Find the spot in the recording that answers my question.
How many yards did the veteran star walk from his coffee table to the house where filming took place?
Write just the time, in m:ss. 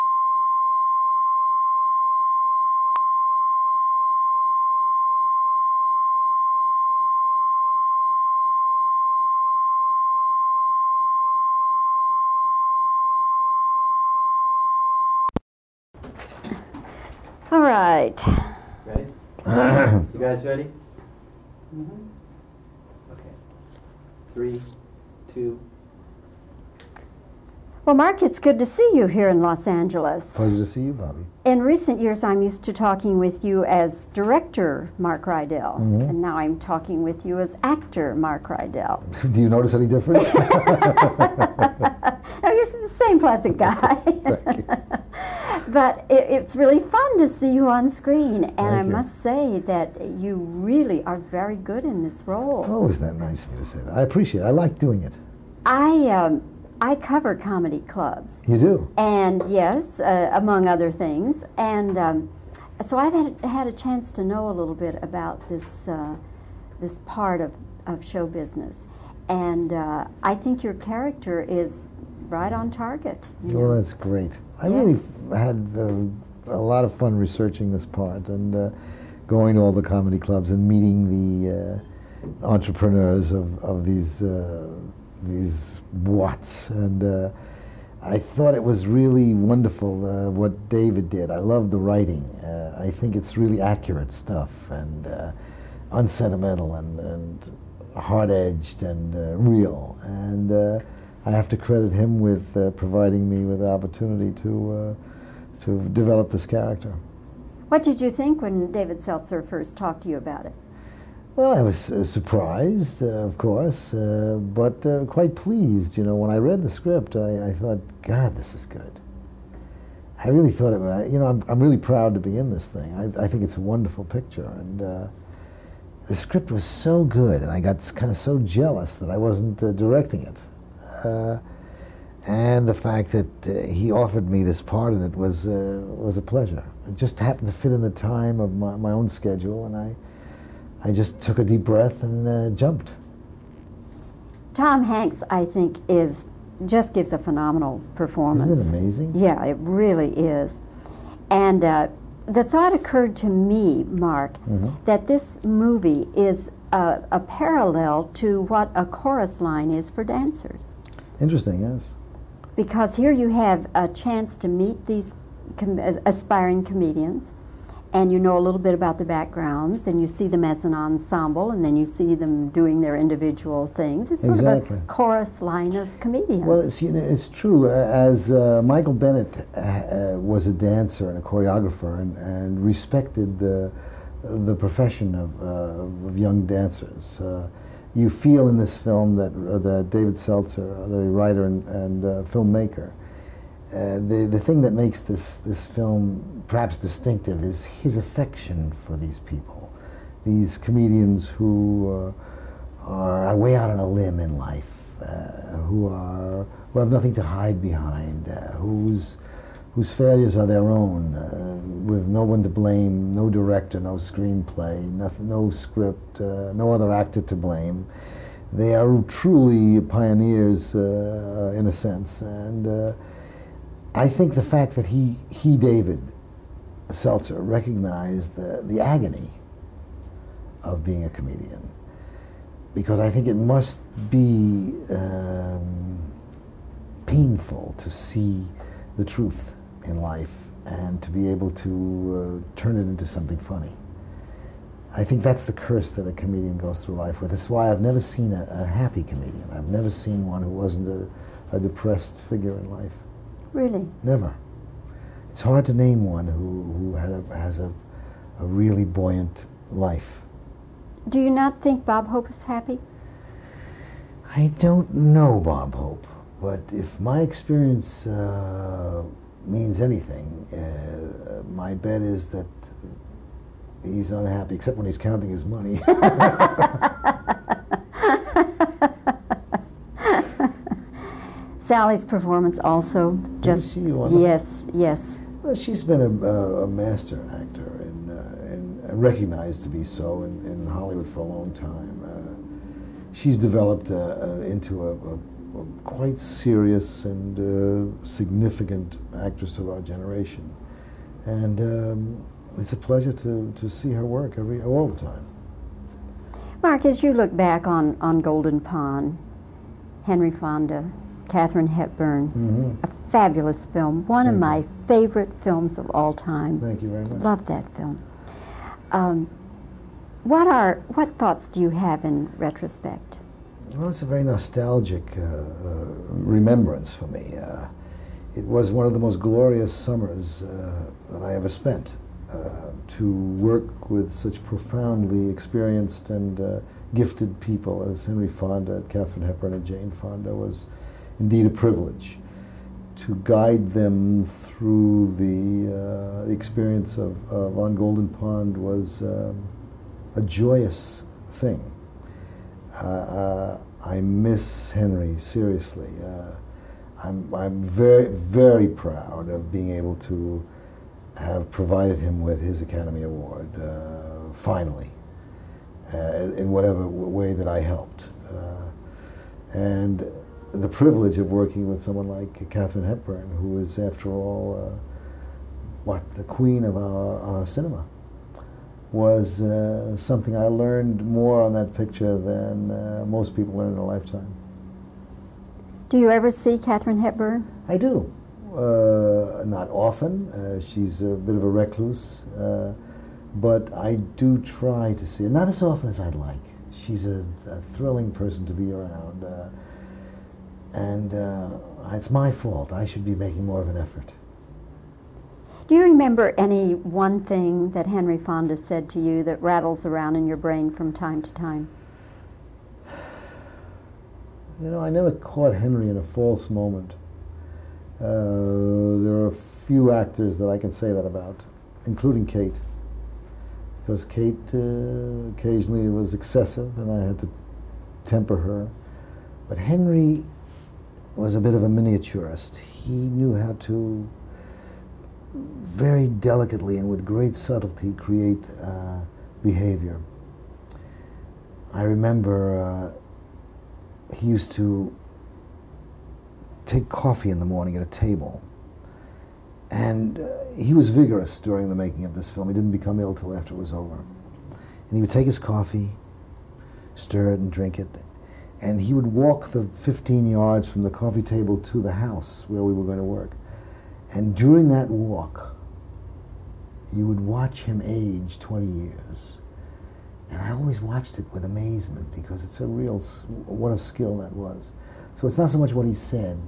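7:39.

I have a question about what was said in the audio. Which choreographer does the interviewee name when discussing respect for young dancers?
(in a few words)
Michael Bennett.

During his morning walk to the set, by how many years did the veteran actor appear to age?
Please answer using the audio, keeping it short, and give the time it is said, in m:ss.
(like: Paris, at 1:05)
20, at 7:48.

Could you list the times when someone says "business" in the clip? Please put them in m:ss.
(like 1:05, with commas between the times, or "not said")
1:08.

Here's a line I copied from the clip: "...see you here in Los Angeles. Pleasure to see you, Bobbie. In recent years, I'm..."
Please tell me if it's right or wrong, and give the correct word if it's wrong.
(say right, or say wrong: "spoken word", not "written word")
right.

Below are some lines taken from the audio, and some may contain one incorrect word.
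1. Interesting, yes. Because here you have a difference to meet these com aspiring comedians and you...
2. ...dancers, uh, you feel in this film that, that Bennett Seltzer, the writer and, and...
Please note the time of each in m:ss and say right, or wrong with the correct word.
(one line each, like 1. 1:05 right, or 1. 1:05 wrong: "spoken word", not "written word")
1. 2:41 wrong: "chance", not "difference"
2. 3:06 wrong: "David", not "Bennett".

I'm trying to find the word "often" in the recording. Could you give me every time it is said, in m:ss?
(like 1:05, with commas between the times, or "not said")
6:29, 6:35.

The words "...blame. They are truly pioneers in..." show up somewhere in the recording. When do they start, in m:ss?
3:37.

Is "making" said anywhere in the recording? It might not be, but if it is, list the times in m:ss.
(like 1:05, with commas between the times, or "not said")
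6:43, 7:31.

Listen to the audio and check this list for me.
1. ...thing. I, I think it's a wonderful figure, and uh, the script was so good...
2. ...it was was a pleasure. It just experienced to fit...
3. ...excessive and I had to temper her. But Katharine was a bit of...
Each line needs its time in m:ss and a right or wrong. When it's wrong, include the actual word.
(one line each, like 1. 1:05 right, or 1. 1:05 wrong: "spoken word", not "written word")
1. 2:02 wrong: "picture", not "figure"
2. 2:15 wrong: "happened", not "experienced"
3. 7:06 wrong: "Henry", not "Katharine".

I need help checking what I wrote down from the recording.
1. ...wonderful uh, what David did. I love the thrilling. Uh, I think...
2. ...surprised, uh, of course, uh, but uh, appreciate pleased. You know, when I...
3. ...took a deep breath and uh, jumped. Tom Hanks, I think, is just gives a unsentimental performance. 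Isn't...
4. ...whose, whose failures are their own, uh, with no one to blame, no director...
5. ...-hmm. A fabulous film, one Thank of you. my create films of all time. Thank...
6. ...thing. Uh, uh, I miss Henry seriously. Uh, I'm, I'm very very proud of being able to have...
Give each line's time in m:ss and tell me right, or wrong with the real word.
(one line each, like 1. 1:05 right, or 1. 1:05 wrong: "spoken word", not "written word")
1. 1:29 wrong: "writing", not "thrilling"
2. 1:52 wrong: "quite", not "appreciate"
3. 2:21 wrong: "phenomenal", not "unsentimental"
4. 3:28 right
5. 5:12 wrong: "favorite", not "create"
6. 5:51 right.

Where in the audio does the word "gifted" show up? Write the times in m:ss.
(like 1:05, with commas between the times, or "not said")
5:36.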